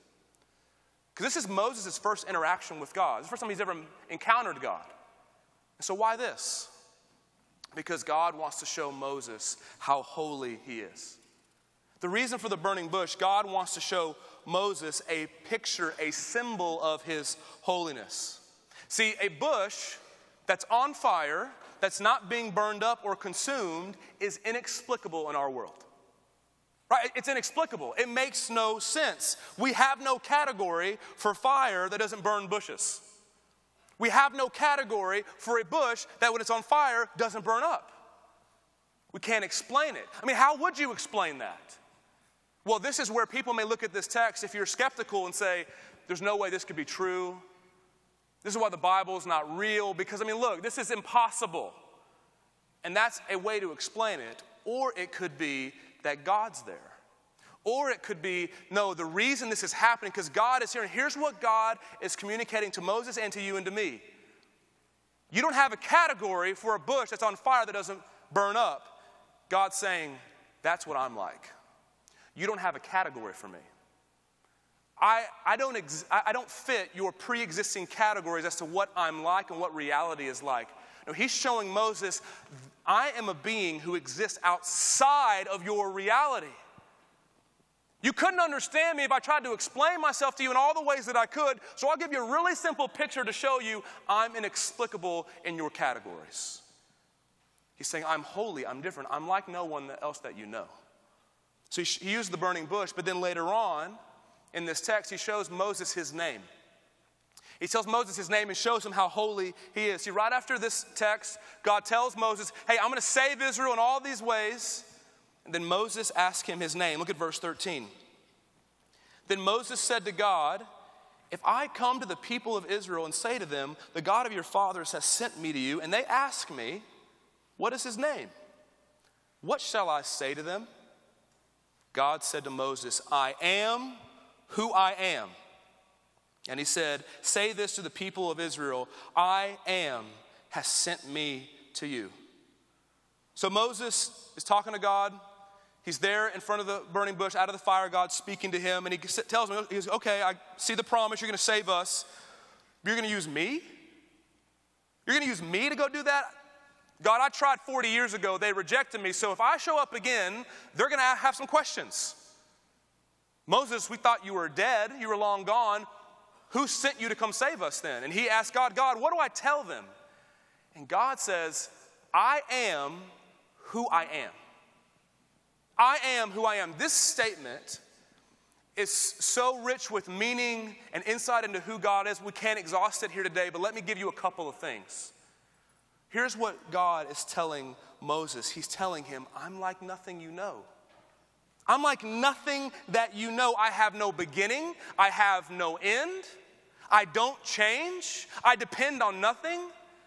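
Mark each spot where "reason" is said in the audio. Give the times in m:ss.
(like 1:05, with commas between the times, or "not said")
0:12, 0:59.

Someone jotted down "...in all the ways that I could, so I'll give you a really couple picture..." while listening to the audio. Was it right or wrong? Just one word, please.
wrong.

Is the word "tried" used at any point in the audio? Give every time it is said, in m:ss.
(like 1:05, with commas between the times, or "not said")
1:29, 2:37.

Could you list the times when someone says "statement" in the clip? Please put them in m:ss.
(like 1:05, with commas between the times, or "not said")
2:56.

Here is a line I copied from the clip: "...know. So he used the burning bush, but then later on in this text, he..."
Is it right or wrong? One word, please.
right.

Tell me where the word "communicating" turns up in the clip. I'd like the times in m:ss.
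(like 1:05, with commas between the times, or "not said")
1:02.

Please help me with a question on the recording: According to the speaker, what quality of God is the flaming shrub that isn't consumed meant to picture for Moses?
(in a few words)
Holiness.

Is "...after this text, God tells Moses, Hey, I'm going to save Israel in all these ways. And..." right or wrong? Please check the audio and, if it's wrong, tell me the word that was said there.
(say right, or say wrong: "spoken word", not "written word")
right.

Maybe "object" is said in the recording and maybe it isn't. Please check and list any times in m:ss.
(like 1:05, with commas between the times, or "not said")
not said.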